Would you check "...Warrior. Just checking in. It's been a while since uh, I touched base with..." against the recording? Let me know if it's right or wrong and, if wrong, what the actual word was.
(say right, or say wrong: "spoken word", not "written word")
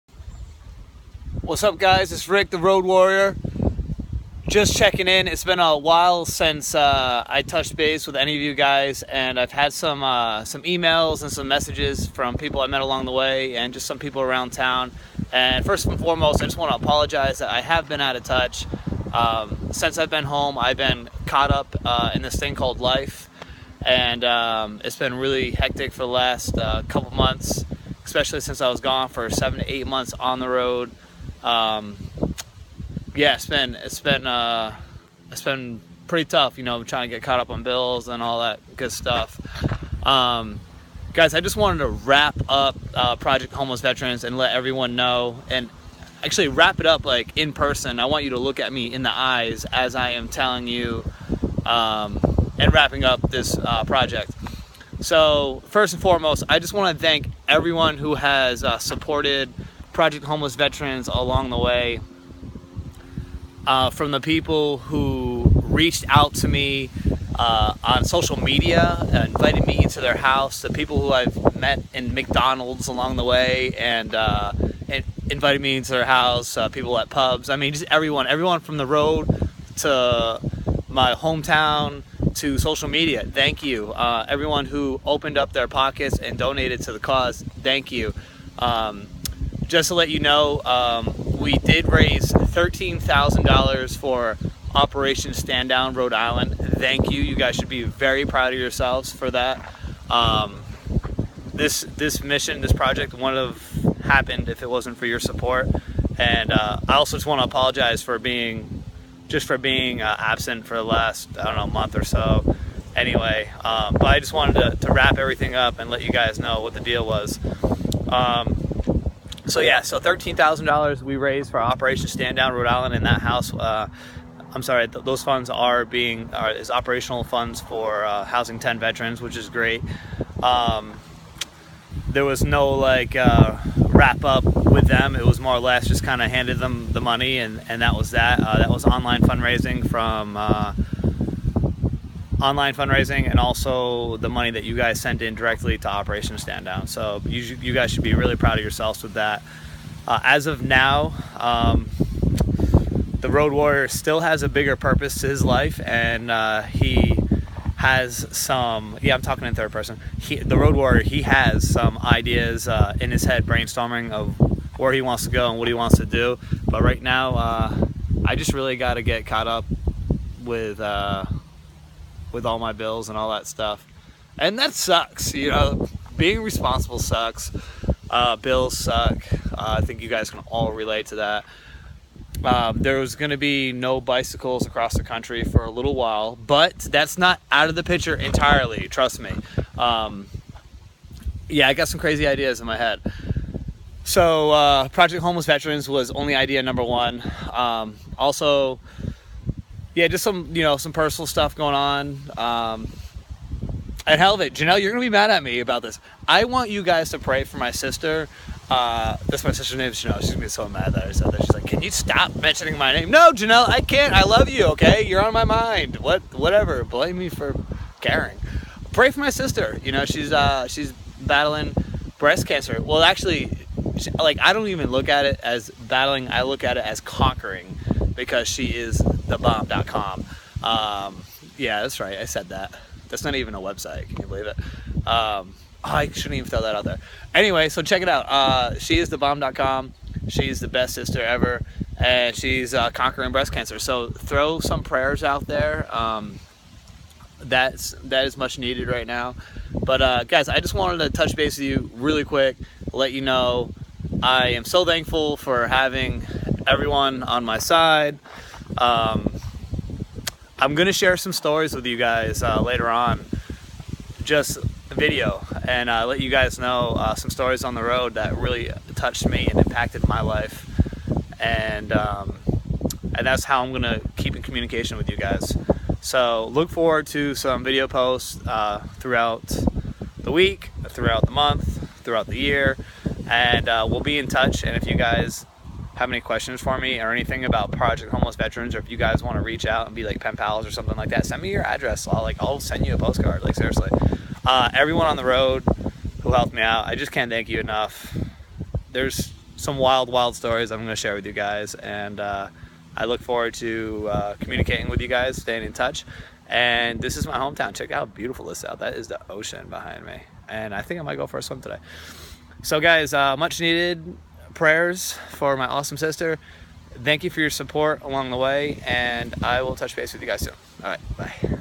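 right.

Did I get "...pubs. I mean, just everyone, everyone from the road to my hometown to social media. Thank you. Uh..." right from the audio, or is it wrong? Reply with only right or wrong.
right.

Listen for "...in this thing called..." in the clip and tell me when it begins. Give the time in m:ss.
0:22.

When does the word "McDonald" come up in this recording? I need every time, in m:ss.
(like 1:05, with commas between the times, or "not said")
1:12.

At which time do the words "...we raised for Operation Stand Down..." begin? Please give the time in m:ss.
2:01.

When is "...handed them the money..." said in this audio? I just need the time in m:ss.
2:16.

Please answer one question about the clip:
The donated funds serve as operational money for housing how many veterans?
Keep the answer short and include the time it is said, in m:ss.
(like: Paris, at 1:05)
10, at 2:08.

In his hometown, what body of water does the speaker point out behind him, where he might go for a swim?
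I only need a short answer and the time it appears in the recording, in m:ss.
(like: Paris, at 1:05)
The ocean, at 5:09.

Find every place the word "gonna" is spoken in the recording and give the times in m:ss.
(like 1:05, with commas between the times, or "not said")
3:24, 3:30, 4:20, 4:33.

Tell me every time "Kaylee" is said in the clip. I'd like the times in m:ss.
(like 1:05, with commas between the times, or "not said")
not said.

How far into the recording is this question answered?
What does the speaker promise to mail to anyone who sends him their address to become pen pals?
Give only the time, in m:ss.
4:52.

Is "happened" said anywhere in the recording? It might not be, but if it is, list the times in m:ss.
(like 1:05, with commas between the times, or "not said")
1:44.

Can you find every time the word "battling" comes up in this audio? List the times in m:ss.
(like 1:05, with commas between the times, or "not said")
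3:41, 3:45.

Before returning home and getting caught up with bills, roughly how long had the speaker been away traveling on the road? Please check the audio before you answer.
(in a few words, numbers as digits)
7 to 8 months.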